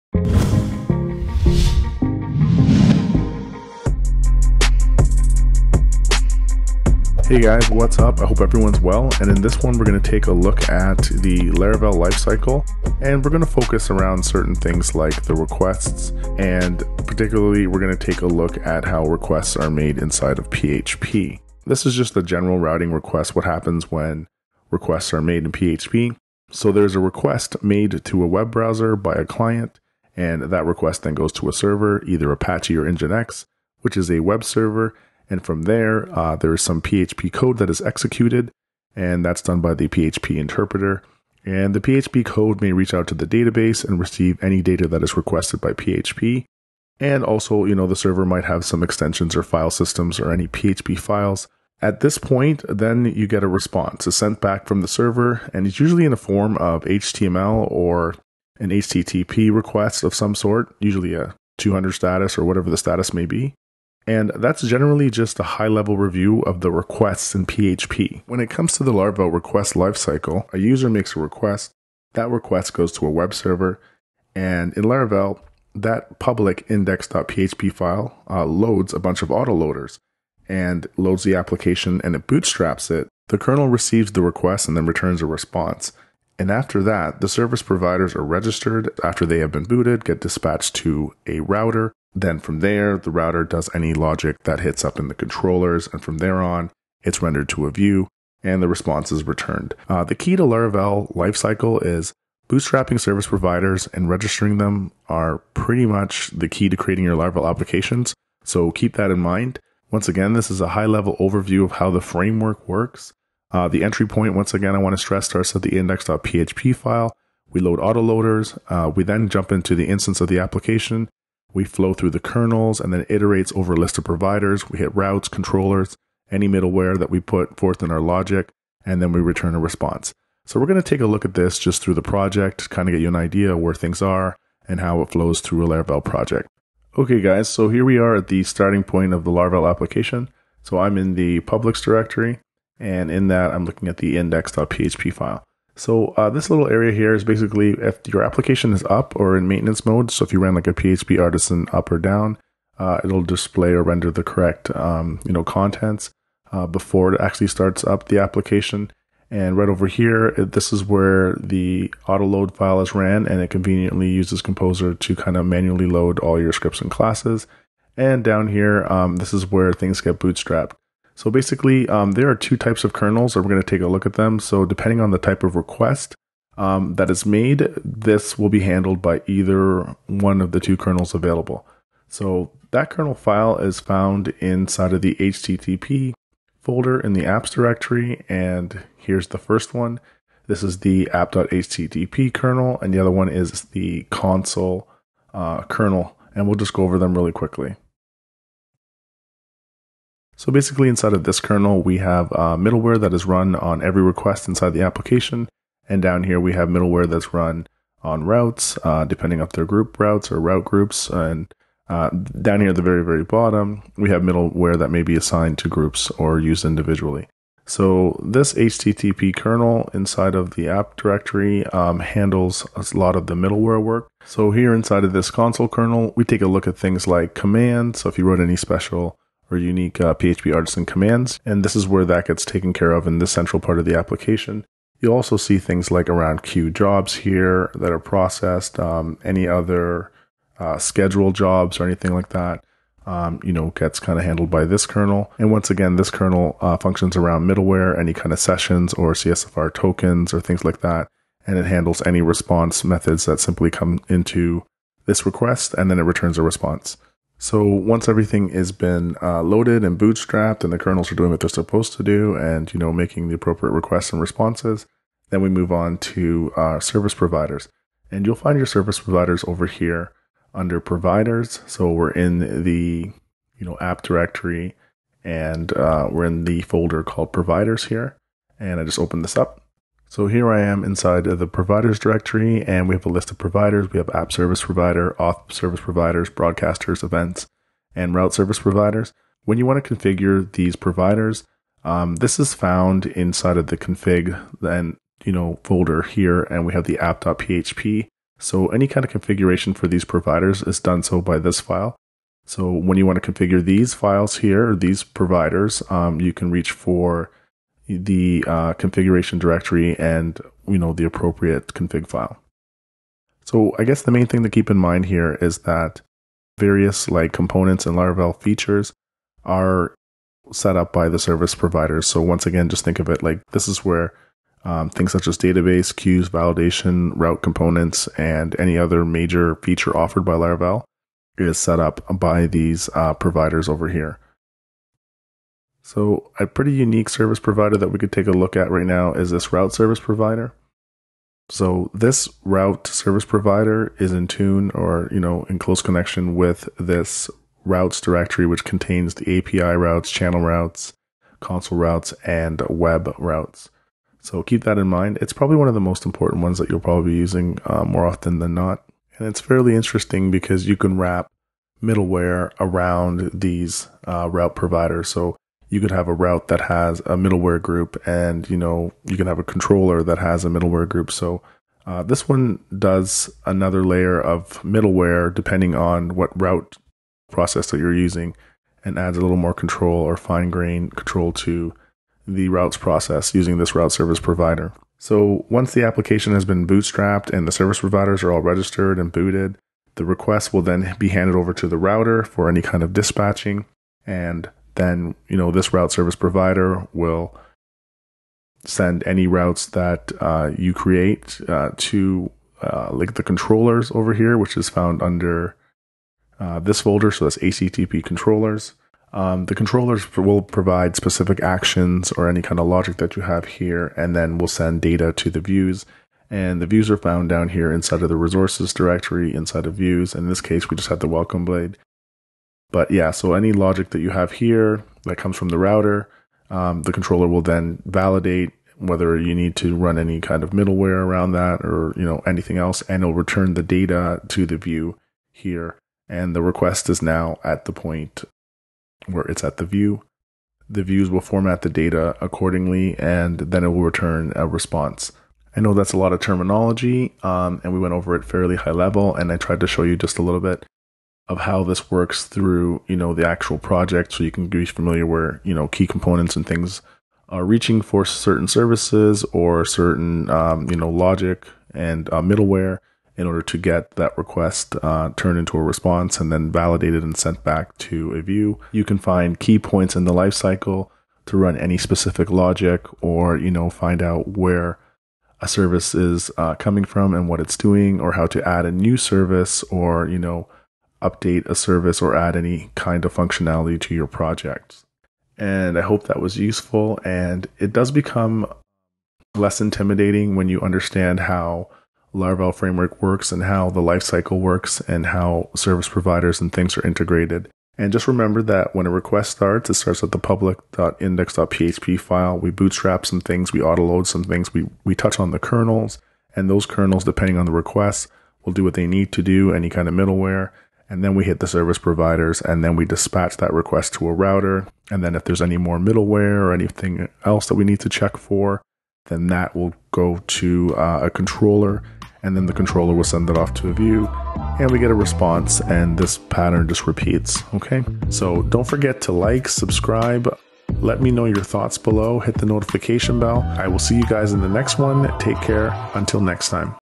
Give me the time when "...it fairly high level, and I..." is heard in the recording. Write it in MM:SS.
07:28.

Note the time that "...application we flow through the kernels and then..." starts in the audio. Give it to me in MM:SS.
02:00.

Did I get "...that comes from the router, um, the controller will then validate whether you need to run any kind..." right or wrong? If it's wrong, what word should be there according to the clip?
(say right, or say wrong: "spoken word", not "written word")
right.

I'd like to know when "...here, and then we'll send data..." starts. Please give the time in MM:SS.
06:53.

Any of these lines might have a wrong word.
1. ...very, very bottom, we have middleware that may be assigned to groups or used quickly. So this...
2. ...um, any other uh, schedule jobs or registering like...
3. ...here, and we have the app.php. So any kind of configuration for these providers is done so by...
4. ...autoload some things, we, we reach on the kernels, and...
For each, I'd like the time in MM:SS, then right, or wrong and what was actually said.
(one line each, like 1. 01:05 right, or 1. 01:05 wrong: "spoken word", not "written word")
1. 03:32 wrong: "individually", not "quickly"
2. 03:58 wrong: "anything", not "registering"
3. 04:56 right
4. 08:23 wrong: "touch", not "reach".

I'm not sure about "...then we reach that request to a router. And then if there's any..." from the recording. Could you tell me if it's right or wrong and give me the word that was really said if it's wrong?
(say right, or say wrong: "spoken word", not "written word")
wrong: "dispatch", not "reach".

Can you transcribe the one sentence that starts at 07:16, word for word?
And the request is now at the point where it's at the view.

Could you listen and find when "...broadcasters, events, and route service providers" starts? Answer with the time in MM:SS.
04:46.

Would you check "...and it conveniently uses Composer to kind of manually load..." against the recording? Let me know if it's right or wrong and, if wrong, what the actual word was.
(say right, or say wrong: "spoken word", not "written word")
right.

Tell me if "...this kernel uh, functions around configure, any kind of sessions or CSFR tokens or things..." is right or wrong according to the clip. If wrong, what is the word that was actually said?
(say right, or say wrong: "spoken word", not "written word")
wrong: "middleware", not "configure".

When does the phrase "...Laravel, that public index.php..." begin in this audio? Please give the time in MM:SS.
01:14.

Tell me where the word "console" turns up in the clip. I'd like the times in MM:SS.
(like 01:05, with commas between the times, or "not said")
03:14, 03:45, 05:51.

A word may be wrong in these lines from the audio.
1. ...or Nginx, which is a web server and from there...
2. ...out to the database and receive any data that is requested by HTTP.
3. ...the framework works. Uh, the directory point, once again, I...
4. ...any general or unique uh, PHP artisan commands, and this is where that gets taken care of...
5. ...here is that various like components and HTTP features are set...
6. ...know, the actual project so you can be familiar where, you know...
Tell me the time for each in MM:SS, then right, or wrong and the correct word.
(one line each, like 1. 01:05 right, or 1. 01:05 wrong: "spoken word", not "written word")
1. 00:32 right
2. 00:42 wrong: "PHP", not "HTTP"
3. 01:51 wrong: "entry", not "directory"
4. 03:48 wrong: "special", not "general"
5. 05:15 wrong: "Laravel", not "HTTP"
6. 07:32 right.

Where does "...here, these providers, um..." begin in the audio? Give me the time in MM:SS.
05:04.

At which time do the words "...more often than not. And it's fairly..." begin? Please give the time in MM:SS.
05:57.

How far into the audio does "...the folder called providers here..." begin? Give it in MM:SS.
04:36.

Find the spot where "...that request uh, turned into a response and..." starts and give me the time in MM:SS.
07:43.